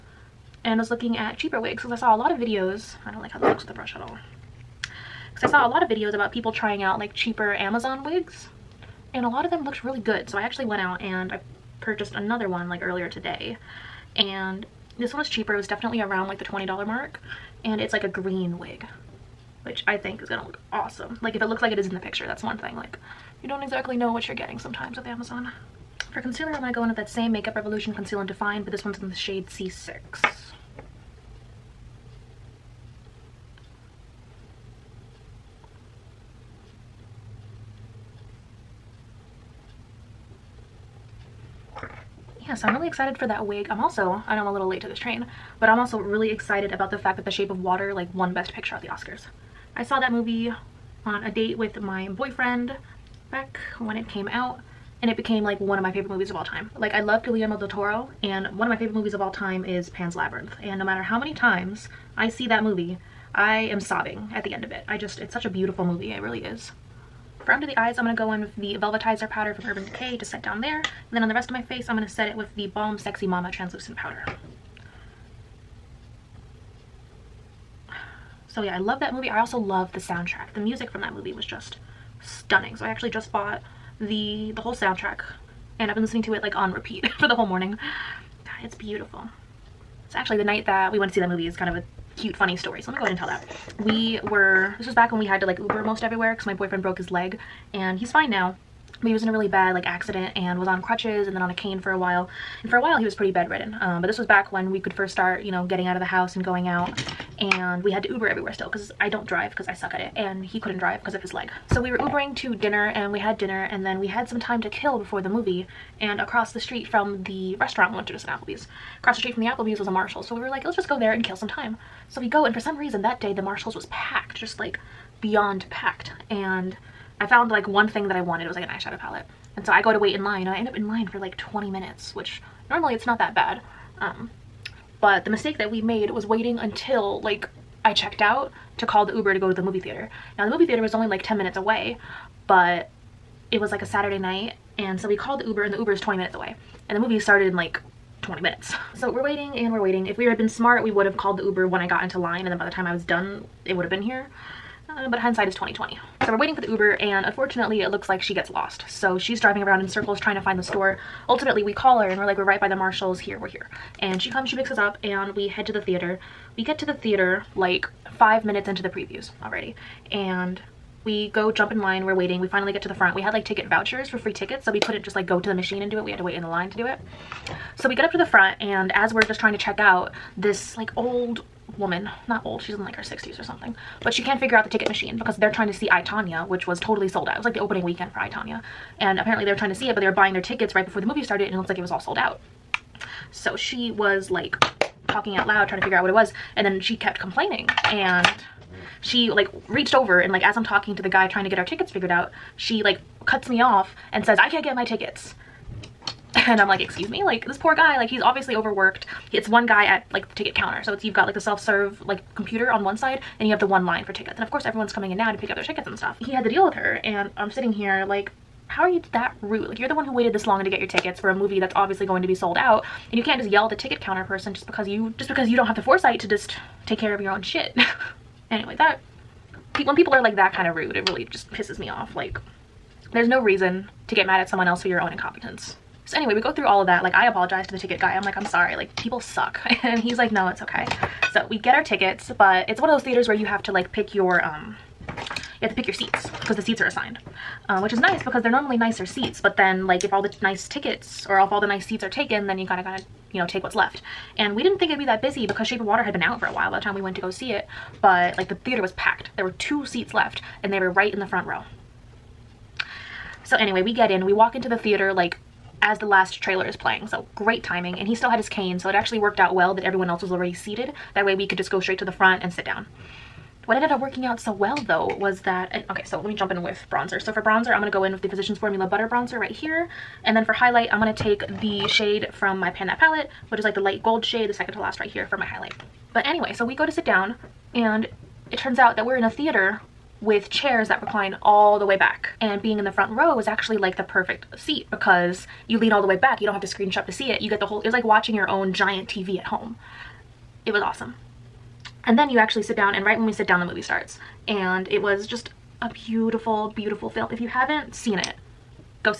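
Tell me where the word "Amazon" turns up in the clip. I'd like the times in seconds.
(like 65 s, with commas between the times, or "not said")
7 s, 25 s.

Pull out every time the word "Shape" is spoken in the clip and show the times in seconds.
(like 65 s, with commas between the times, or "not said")
47 s, 255 s.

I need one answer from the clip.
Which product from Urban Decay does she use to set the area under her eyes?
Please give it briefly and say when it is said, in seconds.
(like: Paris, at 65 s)
Velvetizer powder, at 68 s.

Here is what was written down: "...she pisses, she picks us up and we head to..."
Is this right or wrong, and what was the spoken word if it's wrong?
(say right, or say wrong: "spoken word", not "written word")
wrong: "comes", not "pisses".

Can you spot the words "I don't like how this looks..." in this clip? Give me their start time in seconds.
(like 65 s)
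3 s.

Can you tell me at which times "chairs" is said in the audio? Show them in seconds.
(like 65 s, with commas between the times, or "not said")
290 s.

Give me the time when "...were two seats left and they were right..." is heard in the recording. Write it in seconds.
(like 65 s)
259 s.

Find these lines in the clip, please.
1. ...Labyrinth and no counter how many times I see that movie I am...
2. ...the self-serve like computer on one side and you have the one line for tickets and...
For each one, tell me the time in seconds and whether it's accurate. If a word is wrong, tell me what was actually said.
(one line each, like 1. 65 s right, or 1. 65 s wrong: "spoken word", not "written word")
1. 60 s wrong: "matter", not "counter"
2. 211 s right.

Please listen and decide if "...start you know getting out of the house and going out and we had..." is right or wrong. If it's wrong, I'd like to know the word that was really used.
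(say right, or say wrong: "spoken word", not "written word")
right.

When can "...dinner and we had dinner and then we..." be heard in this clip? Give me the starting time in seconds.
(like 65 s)
112 s.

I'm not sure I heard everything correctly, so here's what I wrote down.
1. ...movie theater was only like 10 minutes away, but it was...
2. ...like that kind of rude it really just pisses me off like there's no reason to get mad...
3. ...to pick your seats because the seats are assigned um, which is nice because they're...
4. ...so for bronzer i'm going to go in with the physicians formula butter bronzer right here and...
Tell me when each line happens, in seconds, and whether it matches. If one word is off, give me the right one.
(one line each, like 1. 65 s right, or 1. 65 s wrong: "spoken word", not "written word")
1. 140 s right
2. 230 s right
3. 245 s right
4. 277 s right.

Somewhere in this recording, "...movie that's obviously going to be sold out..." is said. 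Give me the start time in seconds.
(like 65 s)
221 s.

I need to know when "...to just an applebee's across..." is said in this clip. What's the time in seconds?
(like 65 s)
118 s.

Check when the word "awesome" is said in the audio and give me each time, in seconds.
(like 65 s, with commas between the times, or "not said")
20 s, 300 s.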